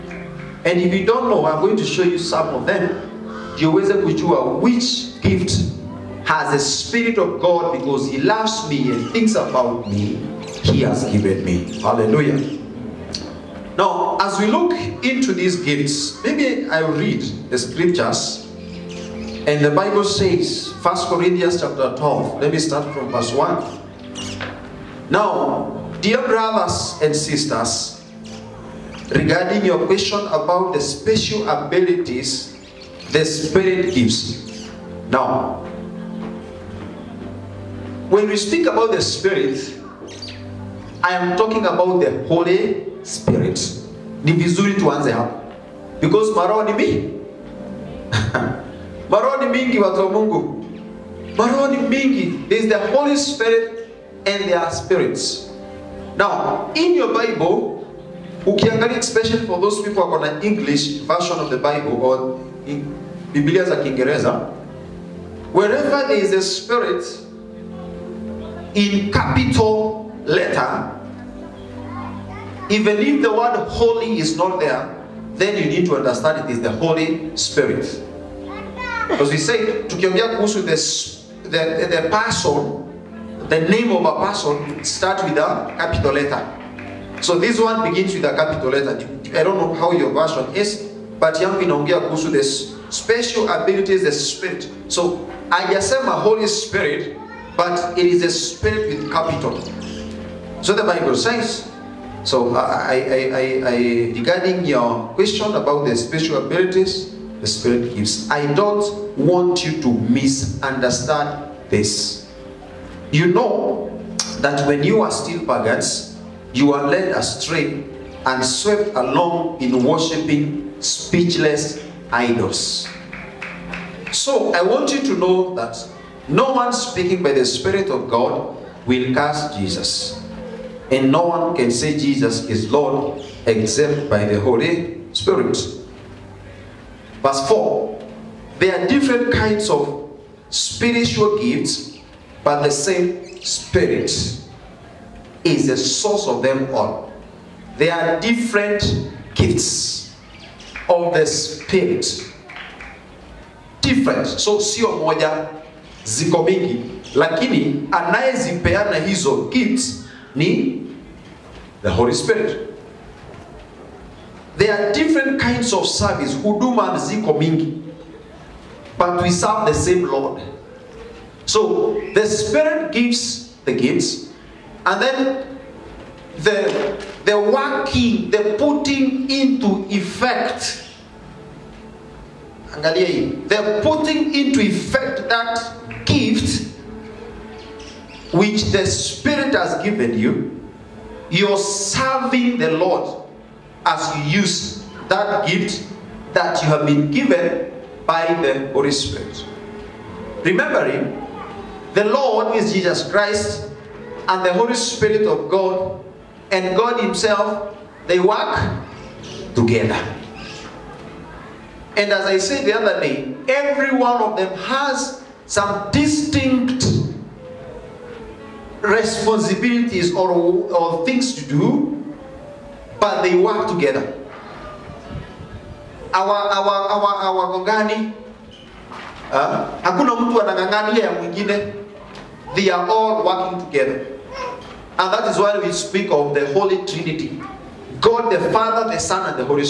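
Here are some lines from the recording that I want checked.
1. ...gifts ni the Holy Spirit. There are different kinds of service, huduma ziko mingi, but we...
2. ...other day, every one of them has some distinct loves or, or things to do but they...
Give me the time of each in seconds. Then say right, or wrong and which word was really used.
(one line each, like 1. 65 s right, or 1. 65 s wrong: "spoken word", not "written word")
1. 159 s right
2. 212 s wrong: "responsibilities", not "loves".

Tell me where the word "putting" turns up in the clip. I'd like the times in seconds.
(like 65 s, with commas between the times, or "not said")
178 s, 183 s.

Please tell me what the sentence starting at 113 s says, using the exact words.
You know that when you are still pagans, you are led astray and swept along in worshipping speechless idols.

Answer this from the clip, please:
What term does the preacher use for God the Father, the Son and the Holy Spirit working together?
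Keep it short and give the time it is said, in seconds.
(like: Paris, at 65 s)
Holy Trinity, at 236 s.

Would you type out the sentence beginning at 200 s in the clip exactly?
Remembering the Lord is Jesus Christ and the Holy Spirit of God and God Himself, they work together.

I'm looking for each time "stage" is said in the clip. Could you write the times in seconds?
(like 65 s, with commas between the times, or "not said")
not said.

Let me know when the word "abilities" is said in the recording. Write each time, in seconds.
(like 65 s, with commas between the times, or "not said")
31 s, 93 s, 106 s.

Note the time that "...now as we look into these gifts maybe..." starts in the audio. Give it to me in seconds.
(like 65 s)
13 s.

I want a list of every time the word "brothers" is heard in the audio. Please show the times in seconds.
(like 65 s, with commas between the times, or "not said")
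26 s.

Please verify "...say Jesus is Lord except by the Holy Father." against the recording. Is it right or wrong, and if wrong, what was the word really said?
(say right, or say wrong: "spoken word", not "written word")
wrong: "Spirit", not "Father".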